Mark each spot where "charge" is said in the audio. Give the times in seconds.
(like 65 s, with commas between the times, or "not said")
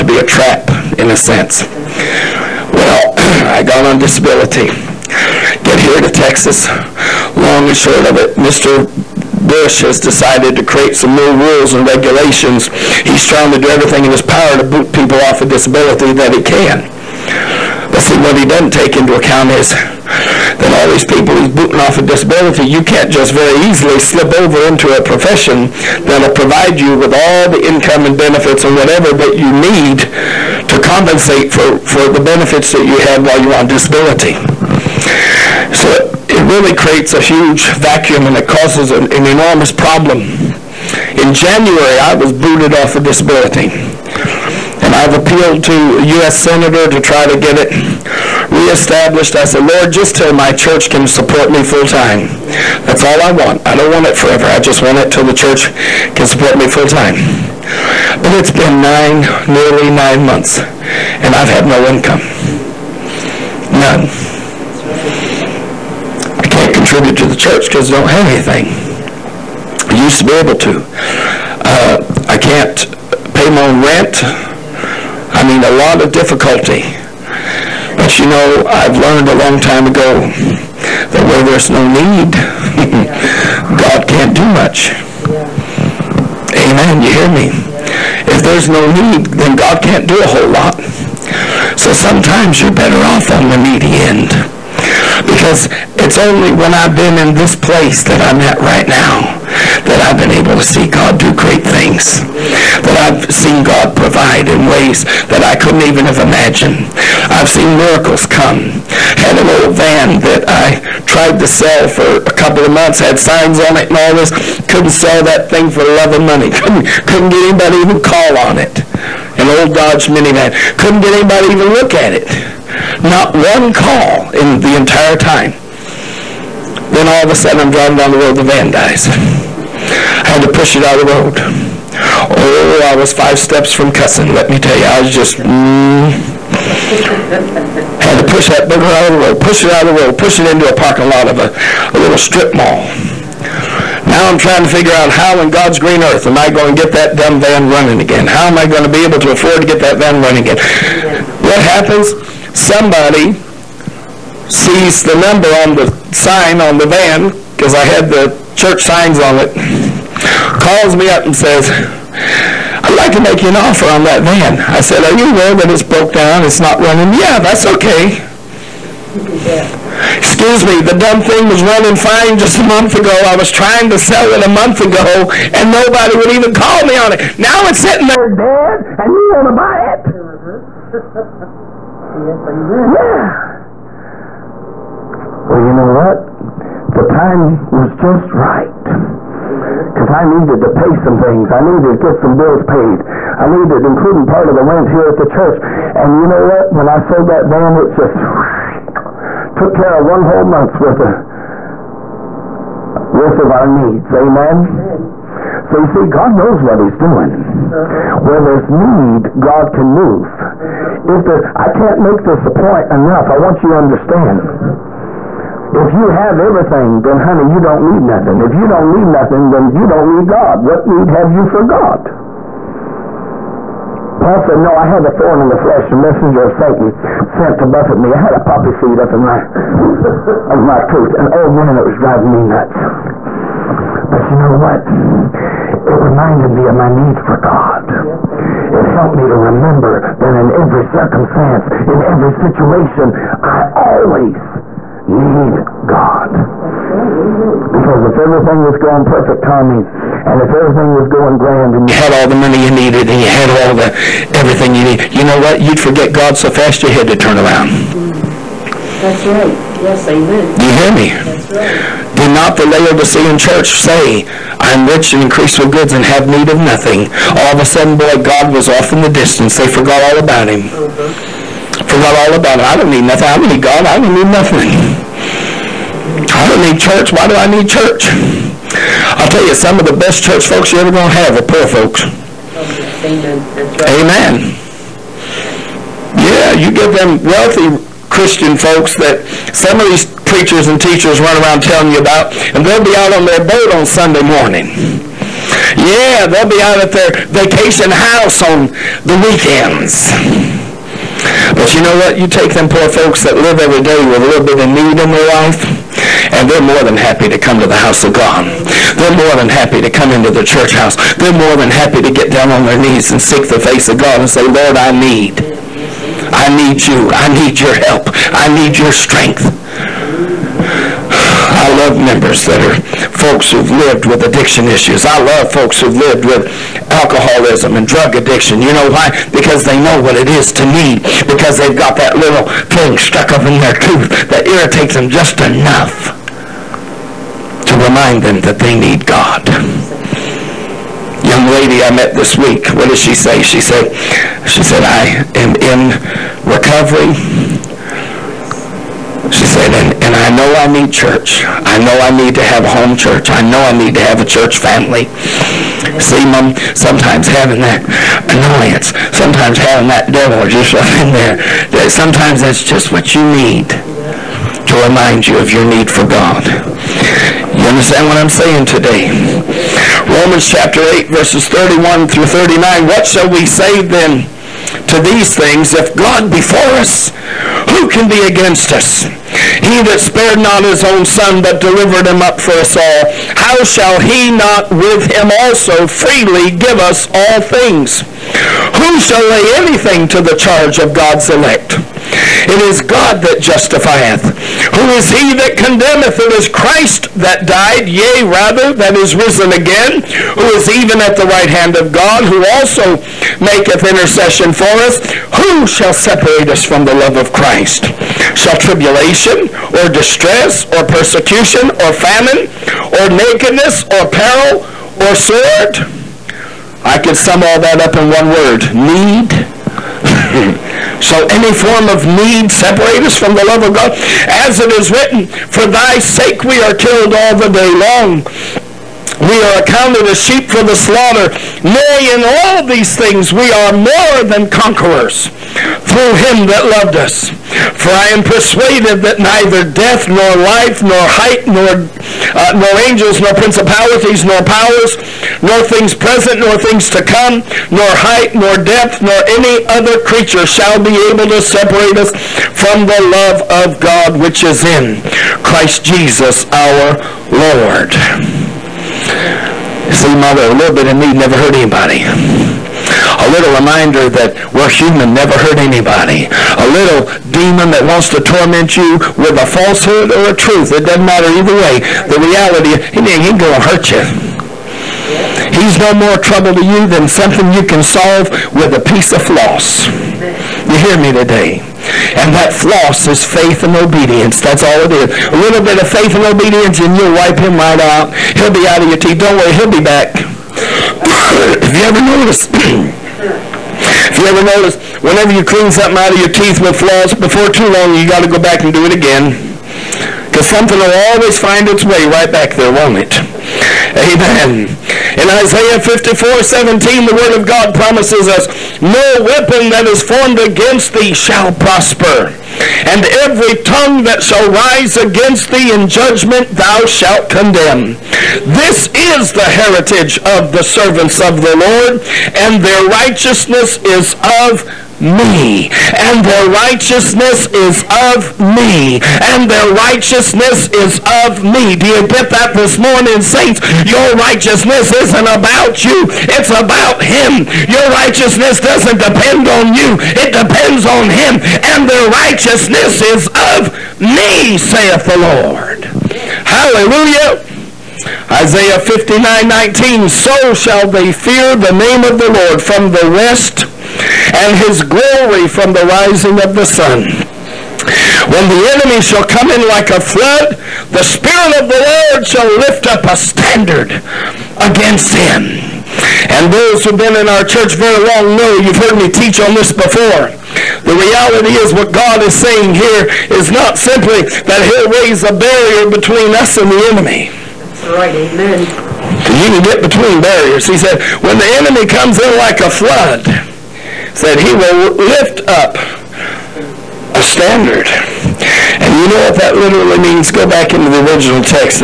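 390 s.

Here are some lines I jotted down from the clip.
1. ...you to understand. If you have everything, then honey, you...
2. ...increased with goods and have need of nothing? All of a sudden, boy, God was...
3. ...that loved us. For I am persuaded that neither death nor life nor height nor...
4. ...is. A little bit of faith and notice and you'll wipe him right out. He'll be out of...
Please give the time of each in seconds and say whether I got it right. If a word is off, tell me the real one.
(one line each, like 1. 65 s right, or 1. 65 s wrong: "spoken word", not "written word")
1. 213 s right
2. 265 s right
3. 436 s right
4. 484 s wrong: "obedience", not "notice".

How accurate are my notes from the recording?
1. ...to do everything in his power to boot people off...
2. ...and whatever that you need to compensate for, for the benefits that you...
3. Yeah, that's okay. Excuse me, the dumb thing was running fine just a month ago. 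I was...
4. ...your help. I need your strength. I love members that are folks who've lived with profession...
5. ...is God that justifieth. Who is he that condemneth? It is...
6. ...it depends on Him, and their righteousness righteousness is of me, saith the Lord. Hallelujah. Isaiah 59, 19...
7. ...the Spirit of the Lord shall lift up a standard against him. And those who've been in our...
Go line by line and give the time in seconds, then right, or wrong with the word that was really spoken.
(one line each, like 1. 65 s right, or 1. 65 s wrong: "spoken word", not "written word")
1. 13 s right
2. 28 s right
3. 167 s right
4. 317 s wrong: "addiction", not "profession"
5. 392 s right
6. 540 s right
7. 560 s right.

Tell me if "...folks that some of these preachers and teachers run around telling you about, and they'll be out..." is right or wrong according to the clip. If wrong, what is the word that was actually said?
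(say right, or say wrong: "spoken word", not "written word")
right.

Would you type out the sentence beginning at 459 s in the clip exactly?
See, mother, a little bit of me never hurt anybody.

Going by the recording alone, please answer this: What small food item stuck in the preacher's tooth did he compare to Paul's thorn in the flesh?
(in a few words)
Poppy seed.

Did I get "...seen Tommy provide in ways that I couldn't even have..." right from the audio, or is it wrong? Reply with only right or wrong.
wrong.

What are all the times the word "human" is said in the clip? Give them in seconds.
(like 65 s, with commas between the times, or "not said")
464 s.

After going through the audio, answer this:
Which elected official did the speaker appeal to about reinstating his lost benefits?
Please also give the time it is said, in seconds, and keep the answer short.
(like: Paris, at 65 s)
U.S. 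Senator, at 46 s.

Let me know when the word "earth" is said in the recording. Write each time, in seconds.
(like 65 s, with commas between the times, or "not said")
146 s.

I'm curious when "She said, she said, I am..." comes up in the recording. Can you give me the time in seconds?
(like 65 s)
343 s.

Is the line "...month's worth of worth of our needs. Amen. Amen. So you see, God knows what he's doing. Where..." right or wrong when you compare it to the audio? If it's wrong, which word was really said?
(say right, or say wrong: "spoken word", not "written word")
right.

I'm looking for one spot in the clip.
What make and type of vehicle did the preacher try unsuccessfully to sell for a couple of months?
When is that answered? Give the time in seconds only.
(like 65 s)
119 s.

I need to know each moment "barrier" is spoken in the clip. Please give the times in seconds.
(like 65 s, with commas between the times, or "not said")
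575 s, 580 s.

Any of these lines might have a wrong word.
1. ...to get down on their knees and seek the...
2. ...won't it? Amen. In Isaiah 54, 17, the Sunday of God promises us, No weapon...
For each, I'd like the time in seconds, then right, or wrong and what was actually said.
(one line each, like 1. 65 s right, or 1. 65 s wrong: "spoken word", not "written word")
1. 311 s right
2. 502 s wrong: "Word", not "Sunday".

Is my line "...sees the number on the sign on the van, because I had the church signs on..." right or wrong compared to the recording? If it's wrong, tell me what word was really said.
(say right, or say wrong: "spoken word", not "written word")
right.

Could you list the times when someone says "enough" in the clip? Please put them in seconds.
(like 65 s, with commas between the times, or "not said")
212 s, 335 s.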